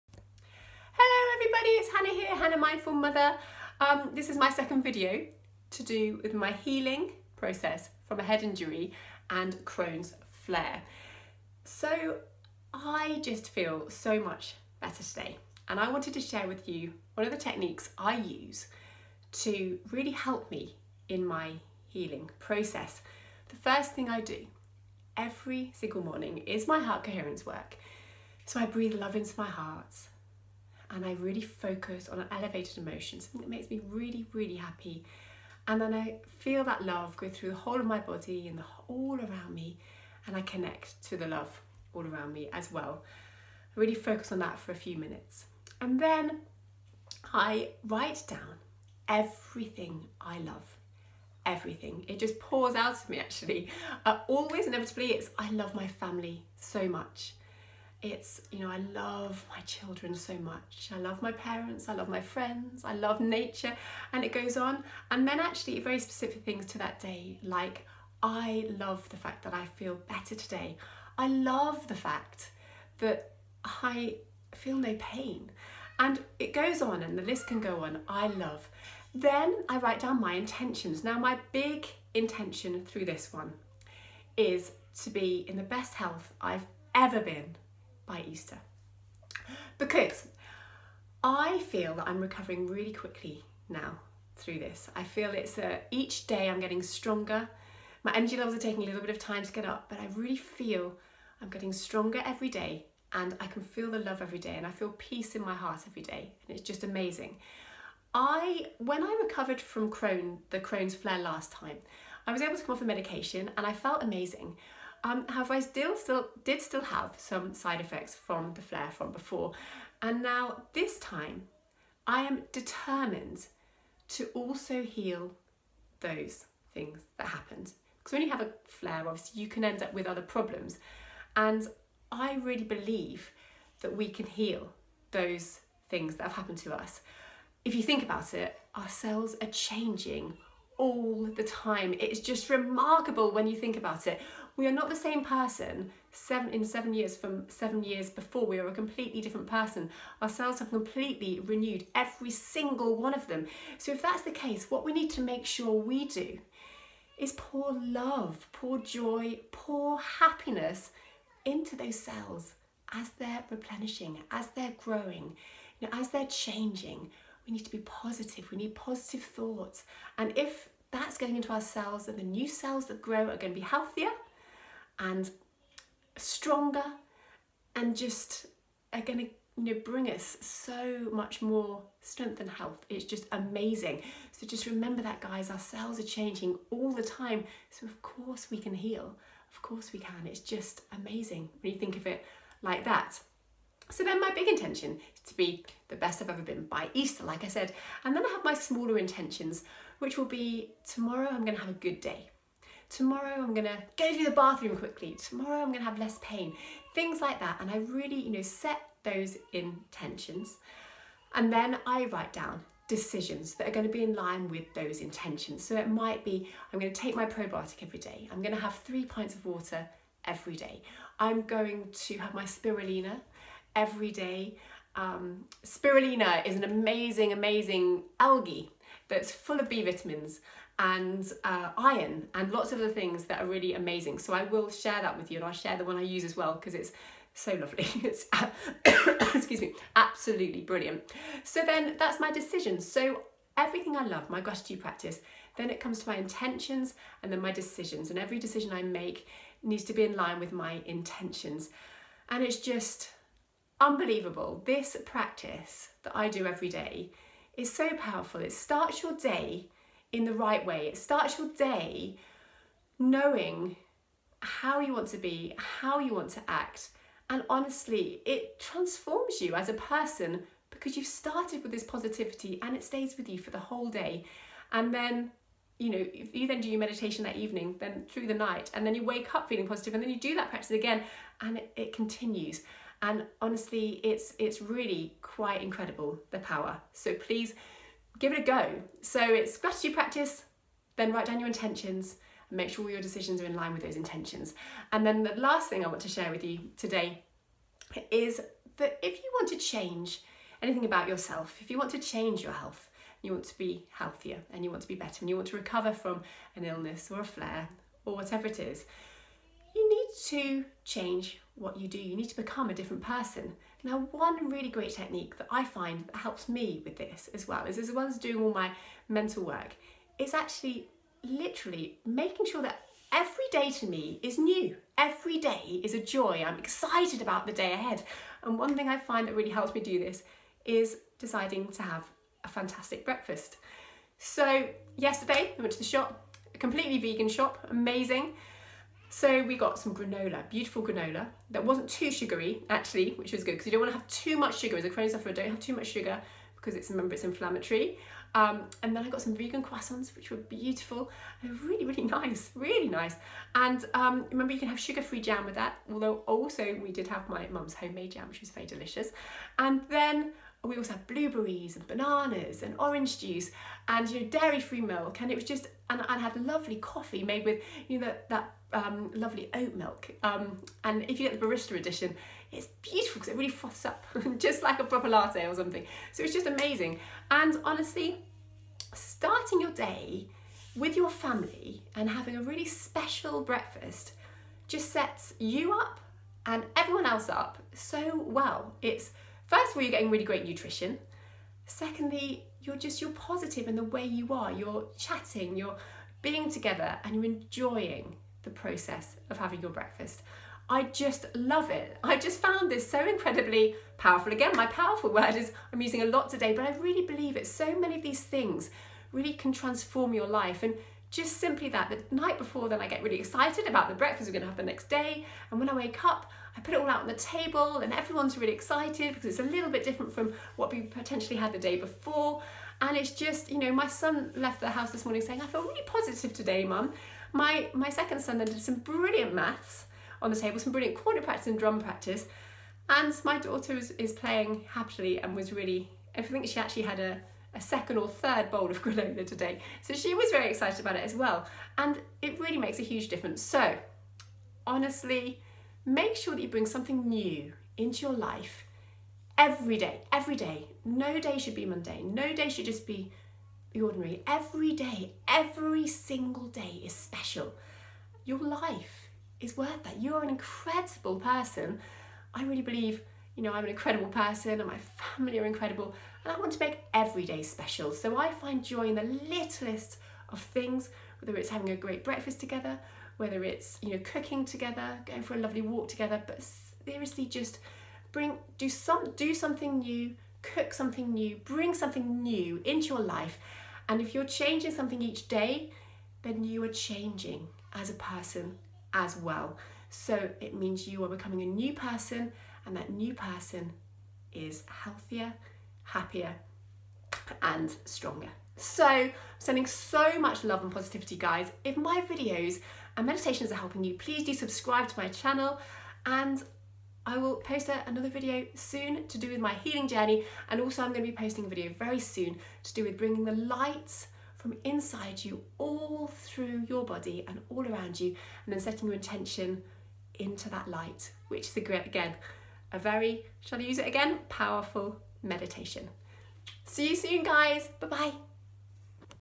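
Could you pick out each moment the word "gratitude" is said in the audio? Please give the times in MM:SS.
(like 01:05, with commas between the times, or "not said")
04:04, 04:49.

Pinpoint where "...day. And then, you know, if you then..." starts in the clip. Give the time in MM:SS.
04:33.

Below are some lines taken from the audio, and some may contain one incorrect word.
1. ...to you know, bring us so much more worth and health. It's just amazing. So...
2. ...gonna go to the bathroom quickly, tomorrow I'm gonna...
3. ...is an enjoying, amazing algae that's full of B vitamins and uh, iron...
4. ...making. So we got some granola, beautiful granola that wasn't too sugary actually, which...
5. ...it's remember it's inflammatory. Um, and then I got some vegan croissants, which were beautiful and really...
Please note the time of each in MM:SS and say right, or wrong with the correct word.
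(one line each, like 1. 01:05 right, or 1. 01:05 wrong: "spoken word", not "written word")
1. 02:59 wrong: "strength", not "worth"
2. 03:23 right
3. 03:46 wrong: "amazing", not "enjoying"
4. 05:37 wrong: "amazing", not "making"
5. 05:46 right.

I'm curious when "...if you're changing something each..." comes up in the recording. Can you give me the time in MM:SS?
08:04.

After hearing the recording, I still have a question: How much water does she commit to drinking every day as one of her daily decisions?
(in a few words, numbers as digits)
3 pints.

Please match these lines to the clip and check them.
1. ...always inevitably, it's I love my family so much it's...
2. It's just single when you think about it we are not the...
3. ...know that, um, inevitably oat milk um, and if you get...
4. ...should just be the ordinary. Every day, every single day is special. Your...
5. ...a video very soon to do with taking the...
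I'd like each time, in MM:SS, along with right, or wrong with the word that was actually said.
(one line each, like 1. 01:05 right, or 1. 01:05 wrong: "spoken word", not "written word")
1. 00:54 right
2. 02:21 wrong: "remarkable", not "single"
3. 06:07 wrong: "lovely", not "inevitably"
4. 07:32 right
5. 08:31 wrong: "bringing", not "taking".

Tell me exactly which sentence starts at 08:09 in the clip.
So it means you are becoming a new person and that new person is healthier, happier, and stronger.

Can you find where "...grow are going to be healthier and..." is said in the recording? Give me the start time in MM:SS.
02:53.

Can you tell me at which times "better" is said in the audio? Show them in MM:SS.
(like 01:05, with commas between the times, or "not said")
00:14, 01:10, 05:04.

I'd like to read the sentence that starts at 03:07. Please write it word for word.
So, of course, we can heal.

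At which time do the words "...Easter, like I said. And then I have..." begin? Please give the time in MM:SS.
03:16.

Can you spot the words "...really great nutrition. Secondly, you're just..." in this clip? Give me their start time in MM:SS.
06:30.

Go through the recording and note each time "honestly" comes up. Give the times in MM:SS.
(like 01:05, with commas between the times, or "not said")
04:27, 04:43, 06:17, 07:24.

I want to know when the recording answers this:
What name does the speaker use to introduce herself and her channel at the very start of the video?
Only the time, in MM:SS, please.
00:02.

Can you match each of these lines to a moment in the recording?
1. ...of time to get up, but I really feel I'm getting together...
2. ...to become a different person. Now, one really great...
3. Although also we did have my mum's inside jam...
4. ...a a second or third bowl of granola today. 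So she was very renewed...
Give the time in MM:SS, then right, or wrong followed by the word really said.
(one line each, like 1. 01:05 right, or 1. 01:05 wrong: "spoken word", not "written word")
1. 01:39 wrong: "stronger", not "together"
2. 05:12 right
3. 05:55 wrong: "homemade", not "inside"
4. 07:17 wrong: "excited", not "renewed".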